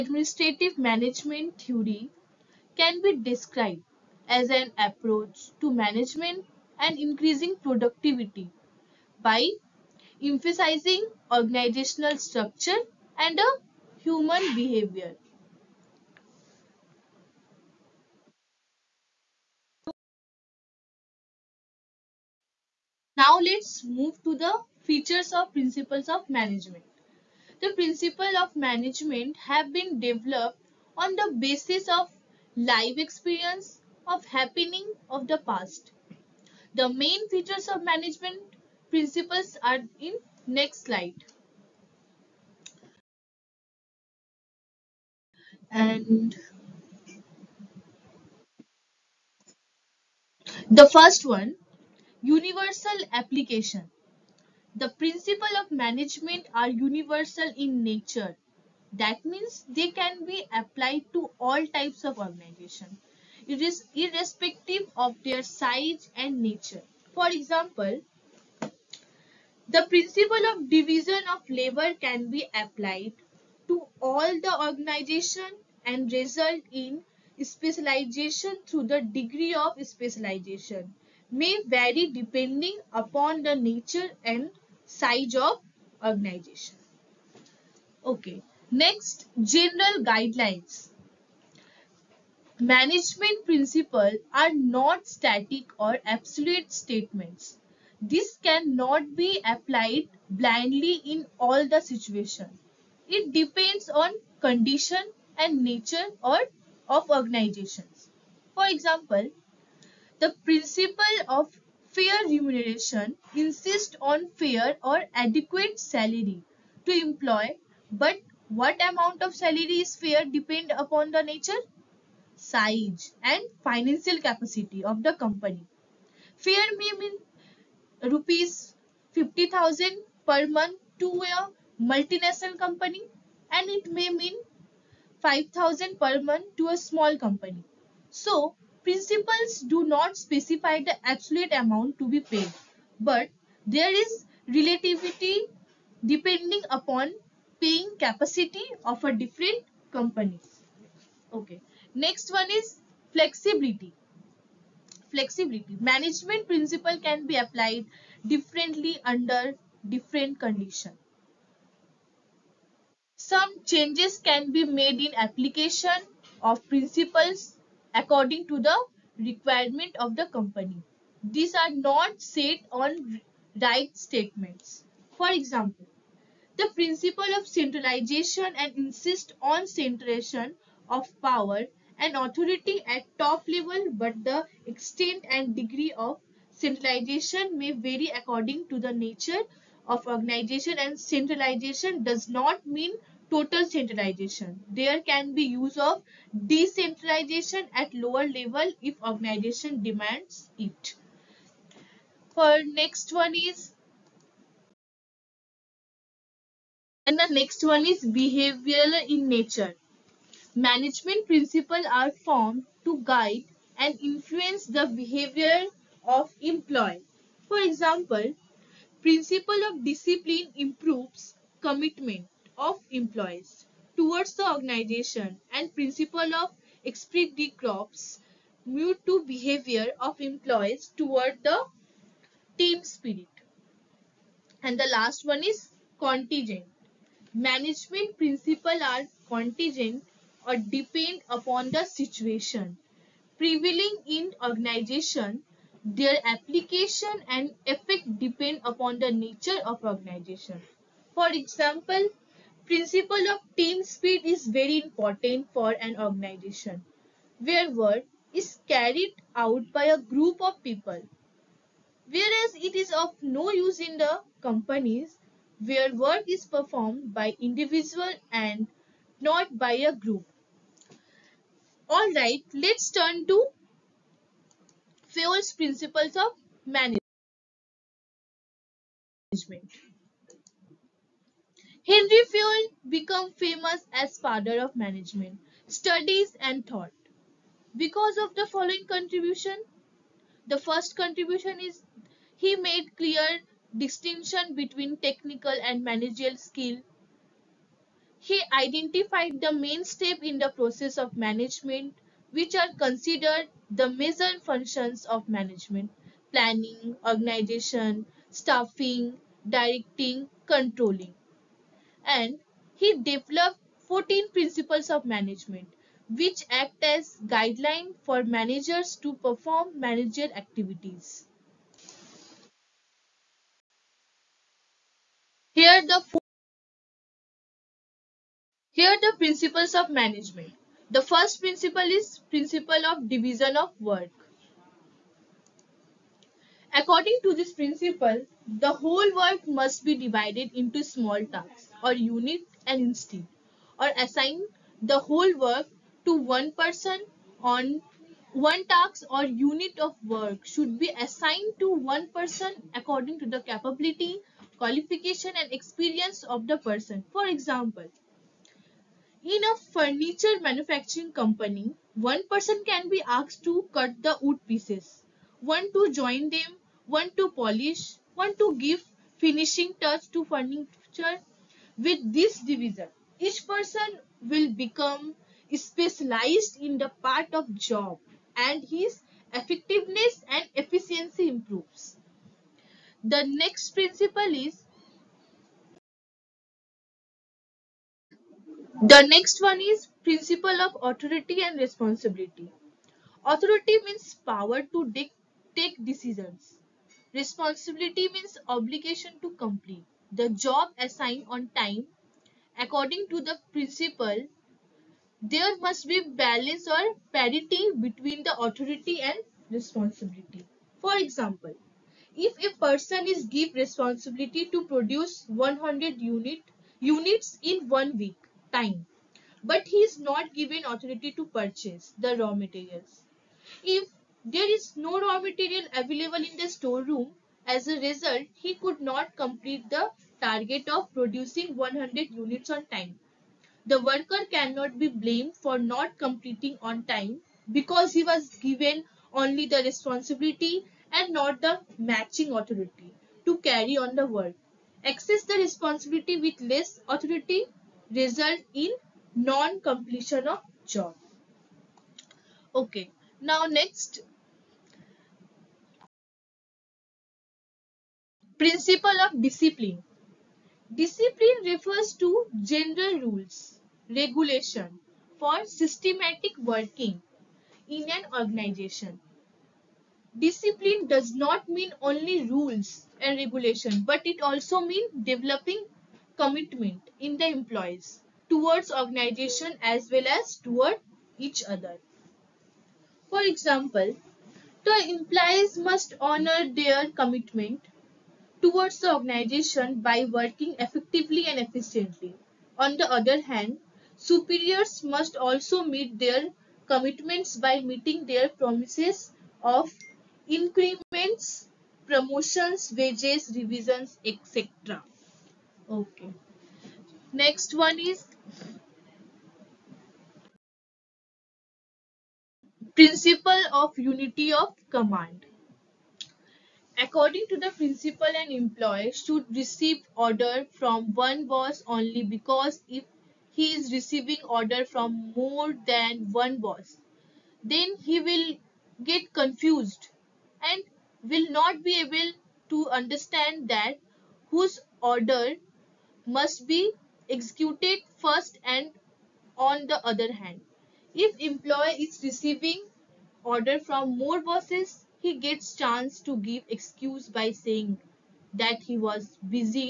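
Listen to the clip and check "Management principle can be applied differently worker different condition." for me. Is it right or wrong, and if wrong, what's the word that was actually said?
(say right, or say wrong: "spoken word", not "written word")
wrong: "under", not "worker".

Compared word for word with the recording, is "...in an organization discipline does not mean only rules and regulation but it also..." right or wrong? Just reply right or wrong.
right.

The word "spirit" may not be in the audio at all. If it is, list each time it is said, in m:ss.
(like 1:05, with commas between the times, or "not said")
3:52, 4:13.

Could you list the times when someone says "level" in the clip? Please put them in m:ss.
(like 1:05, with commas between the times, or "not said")
3:03, 3:18.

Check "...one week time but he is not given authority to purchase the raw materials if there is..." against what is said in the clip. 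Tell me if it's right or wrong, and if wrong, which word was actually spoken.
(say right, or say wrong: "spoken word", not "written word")
right.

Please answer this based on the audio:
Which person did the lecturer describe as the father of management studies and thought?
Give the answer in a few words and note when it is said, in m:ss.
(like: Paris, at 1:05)
Henry Fayol, at 4:41.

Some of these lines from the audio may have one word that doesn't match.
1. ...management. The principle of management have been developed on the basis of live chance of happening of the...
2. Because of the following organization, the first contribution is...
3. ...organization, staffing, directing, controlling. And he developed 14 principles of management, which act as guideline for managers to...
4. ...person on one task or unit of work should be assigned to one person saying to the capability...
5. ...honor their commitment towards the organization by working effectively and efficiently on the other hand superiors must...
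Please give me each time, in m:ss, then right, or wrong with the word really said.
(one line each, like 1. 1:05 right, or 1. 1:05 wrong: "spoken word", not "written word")
1. 0:26 wrong: "experience", not "chance"
2. 4:47 wrong: "contribution", not "organization"
3. 5:07 right
4. 5:46 wrong: "according", not "saying"
5. 8:06 right.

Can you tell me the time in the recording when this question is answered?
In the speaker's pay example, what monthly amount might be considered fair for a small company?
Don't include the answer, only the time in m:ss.
2:15.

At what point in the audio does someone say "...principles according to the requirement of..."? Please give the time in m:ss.
2:46.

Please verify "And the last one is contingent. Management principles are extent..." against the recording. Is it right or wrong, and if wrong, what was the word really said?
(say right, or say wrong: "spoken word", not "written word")
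wrong: "contingent", not "extent".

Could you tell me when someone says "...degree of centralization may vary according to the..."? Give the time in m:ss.
3:05.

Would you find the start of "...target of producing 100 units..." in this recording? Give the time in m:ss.
7:10.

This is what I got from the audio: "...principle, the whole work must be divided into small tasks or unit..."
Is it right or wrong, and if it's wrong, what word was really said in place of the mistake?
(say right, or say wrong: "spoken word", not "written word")
right.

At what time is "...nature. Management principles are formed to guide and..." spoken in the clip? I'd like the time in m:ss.
3:29.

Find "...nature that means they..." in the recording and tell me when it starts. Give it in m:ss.
0:57.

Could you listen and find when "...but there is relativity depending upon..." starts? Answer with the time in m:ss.
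2:22.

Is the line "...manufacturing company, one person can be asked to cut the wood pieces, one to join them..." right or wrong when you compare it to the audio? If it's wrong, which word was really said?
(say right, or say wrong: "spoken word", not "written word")
right.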